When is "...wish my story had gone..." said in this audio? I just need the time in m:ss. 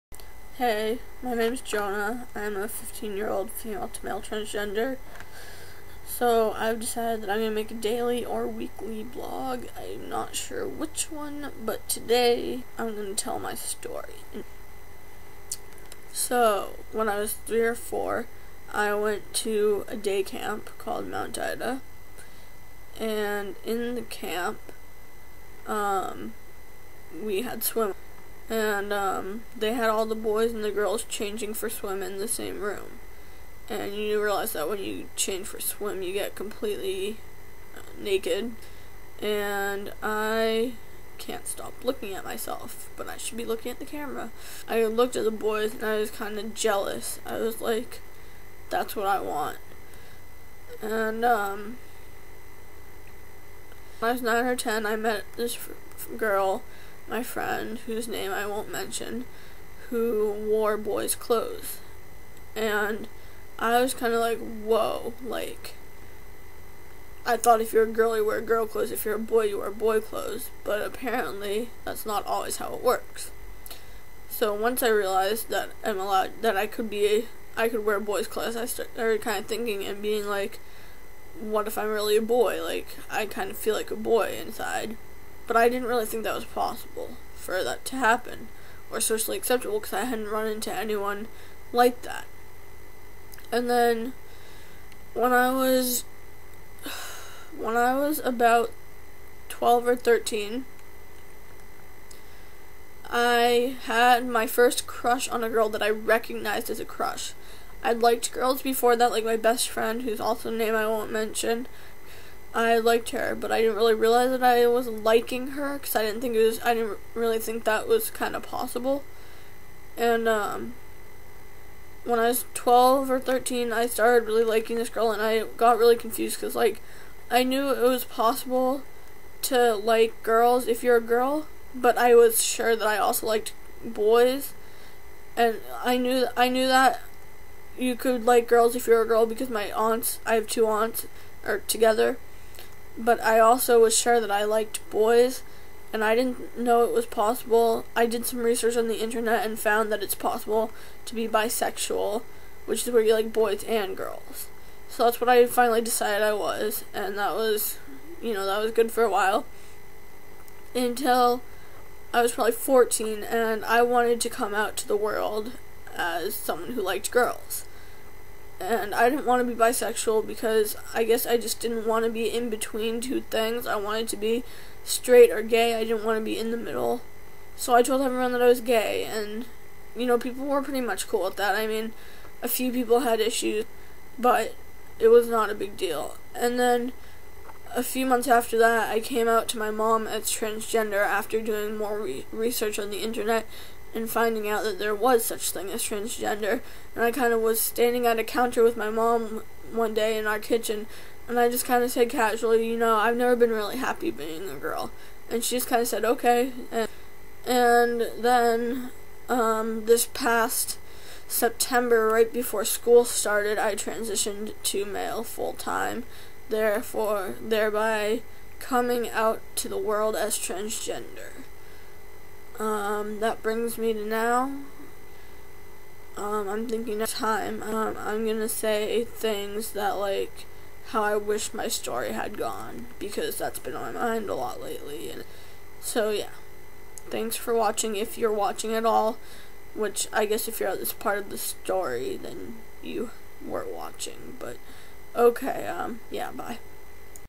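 3:51.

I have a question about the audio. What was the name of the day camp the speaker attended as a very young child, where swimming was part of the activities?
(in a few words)
Mount Ida.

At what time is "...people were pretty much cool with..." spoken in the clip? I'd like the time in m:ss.
3:00.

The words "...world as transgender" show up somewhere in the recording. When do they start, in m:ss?
3:39.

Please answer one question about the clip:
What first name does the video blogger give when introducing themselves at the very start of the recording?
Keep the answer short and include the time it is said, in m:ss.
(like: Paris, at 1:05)
Jonah, at 0:01.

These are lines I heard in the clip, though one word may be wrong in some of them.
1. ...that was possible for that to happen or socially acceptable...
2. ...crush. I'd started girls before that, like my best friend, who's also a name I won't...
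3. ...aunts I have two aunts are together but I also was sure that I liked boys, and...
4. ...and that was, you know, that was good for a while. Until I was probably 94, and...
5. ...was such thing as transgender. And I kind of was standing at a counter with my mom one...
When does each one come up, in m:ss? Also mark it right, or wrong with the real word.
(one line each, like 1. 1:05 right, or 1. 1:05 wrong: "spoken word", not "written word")
1. 1:26 right
2. 1:46 wrong: "liked", not "started"
3. 2:19 right
4. 2:36 wrong: "14", not "94"
5. 3:14 right.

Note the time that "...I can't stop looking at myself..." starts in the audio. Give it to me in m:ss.
0:40.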